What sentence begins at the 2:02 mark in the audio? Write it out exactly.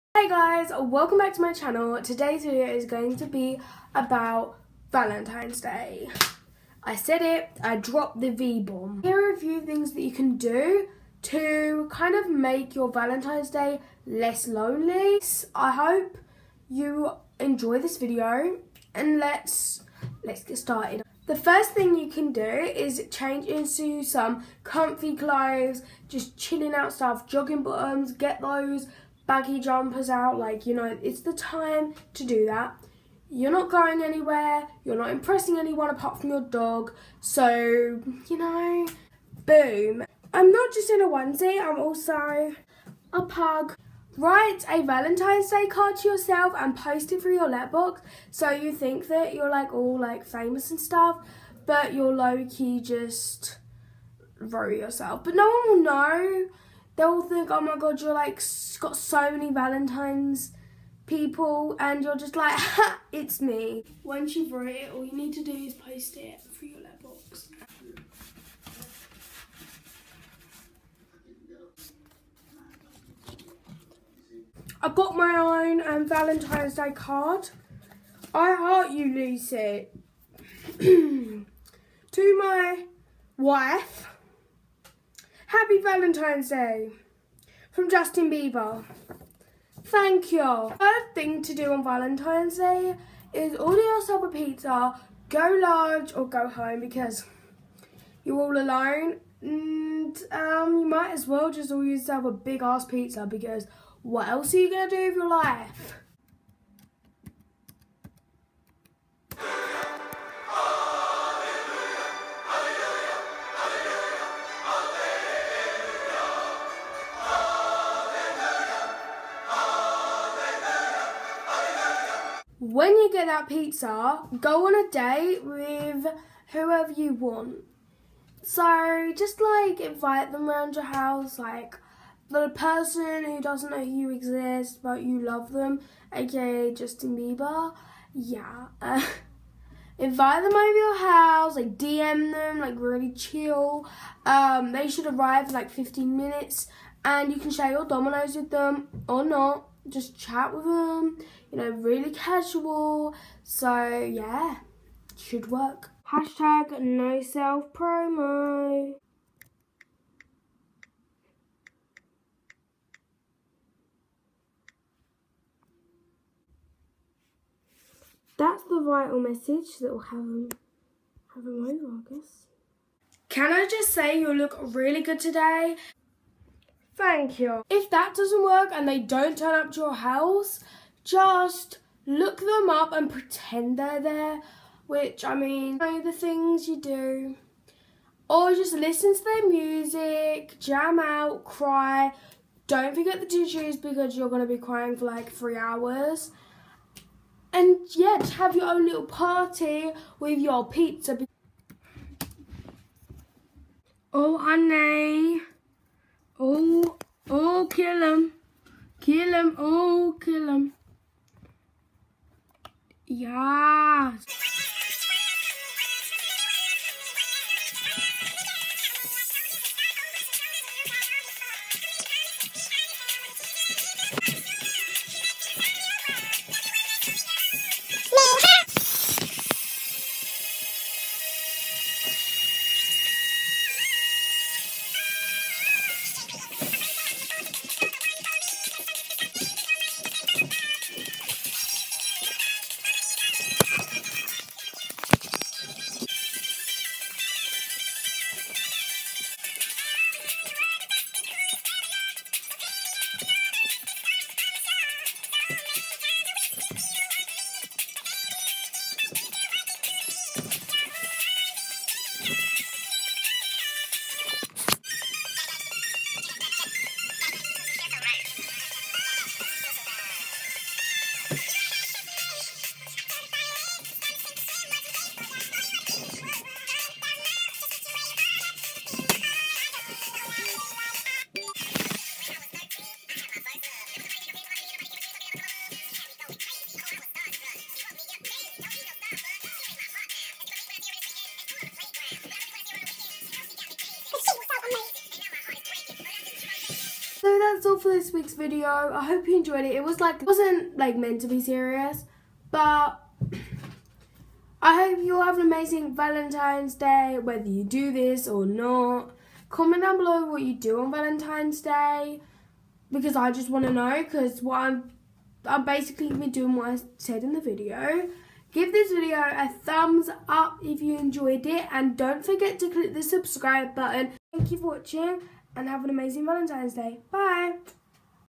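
when you get that pizza, go on a date with whoever you want.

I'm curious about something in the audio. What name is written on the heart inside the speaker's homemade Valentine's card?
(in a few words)
Lucy.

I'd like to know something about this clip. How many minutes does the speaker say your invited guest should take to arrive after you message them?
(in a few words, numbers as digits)
15.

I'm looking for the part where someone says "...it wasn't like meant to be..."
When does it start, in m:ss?
5:00.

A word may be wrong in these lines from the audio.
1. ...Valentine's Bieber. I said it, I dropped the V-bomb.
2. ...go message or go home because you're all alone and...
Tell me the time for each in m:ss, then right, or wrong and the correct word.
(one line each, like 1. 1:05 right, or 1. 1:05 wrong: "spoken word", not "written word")
1. 0:04 wrong: "Day", not "Bieber"
2. 1:35 wrong: "large", not "message".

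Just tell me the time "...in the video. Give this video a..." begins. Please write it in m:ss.
5:17.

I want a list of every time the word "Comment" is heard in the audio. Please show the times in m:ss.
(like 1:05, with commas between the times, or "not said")
5:09.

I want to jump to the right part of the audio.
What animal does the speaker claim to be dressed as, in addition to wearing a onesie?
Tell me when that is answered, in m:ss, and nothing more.
0:43.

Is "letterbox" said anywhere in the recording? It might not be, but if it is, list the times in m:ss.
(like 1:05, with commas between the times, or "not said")
0:47, 1:06.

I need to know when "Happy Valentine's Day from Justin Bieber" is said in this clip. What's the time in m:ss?
1:25.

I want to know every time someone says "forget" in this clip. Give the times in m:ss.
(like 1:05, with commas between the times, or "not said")
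3:12, 5:22.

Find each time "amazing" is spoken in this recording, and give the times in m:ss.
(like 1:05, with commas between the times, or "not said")
5:05, 5:25.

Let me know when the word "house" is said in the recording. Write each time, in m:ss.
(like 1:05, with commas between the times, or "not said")
2:10, 2:20, 2:59.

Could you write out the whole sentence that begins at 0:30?
Like, you know, it's the time to do that.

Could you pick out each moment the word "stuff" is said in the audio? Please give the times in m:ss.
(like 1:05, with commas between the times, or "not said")
0:26, 0:50.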